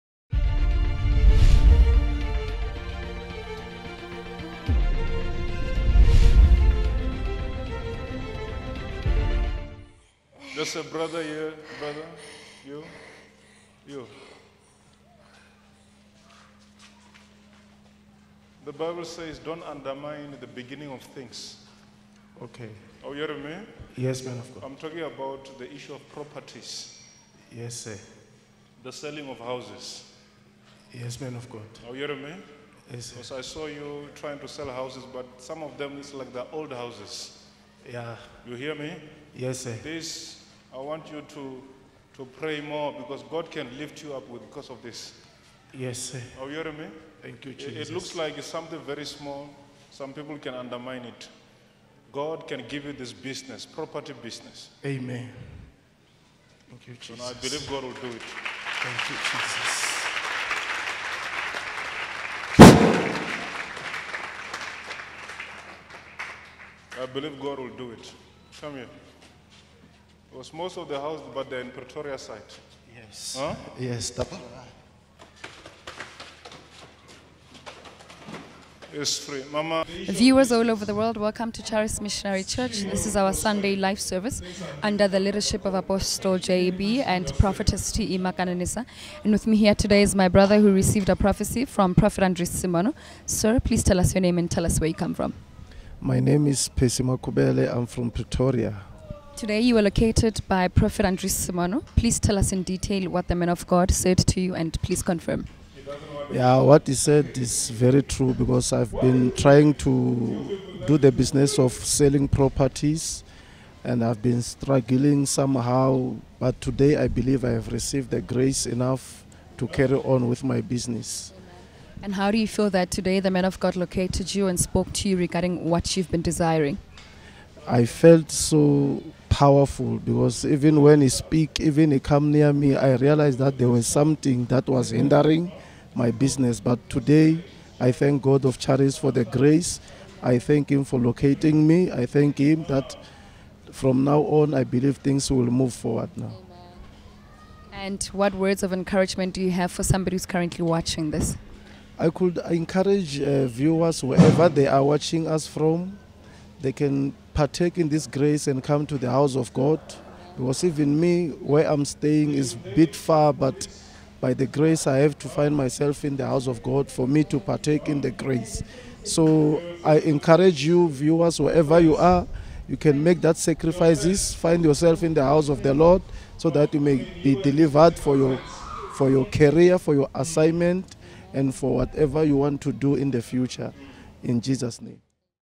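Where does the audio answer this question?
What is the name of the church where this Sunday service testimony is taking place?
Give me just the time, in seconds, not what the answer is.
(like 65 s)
81 s.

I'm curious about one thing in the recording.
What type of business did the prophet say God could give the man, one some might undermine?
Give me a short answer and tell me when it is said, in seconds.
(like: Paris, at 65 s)
Property business, at 53 s.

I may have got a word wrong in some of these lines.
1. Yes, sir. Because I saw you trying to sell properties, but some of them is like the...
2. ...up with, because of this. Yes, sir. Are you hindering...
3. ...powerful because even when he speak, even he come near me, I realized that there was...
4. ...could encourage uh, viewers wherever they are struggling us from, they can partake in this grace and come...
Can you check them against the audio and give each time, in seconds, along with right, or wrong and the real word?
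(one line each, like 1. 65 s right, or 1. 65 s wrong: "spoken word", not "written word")
1. 32 s wrong: "houses", not "properties"
2. 44 s wrong: "hearing", not "hindering"
3. 129 s right
4. 152 s wrong: "watching", not "struggling".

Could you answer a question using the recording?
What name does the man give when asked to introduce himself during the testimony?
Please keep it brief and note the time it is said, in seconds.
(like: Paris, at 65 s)
Pesima Kubele, at 96 s.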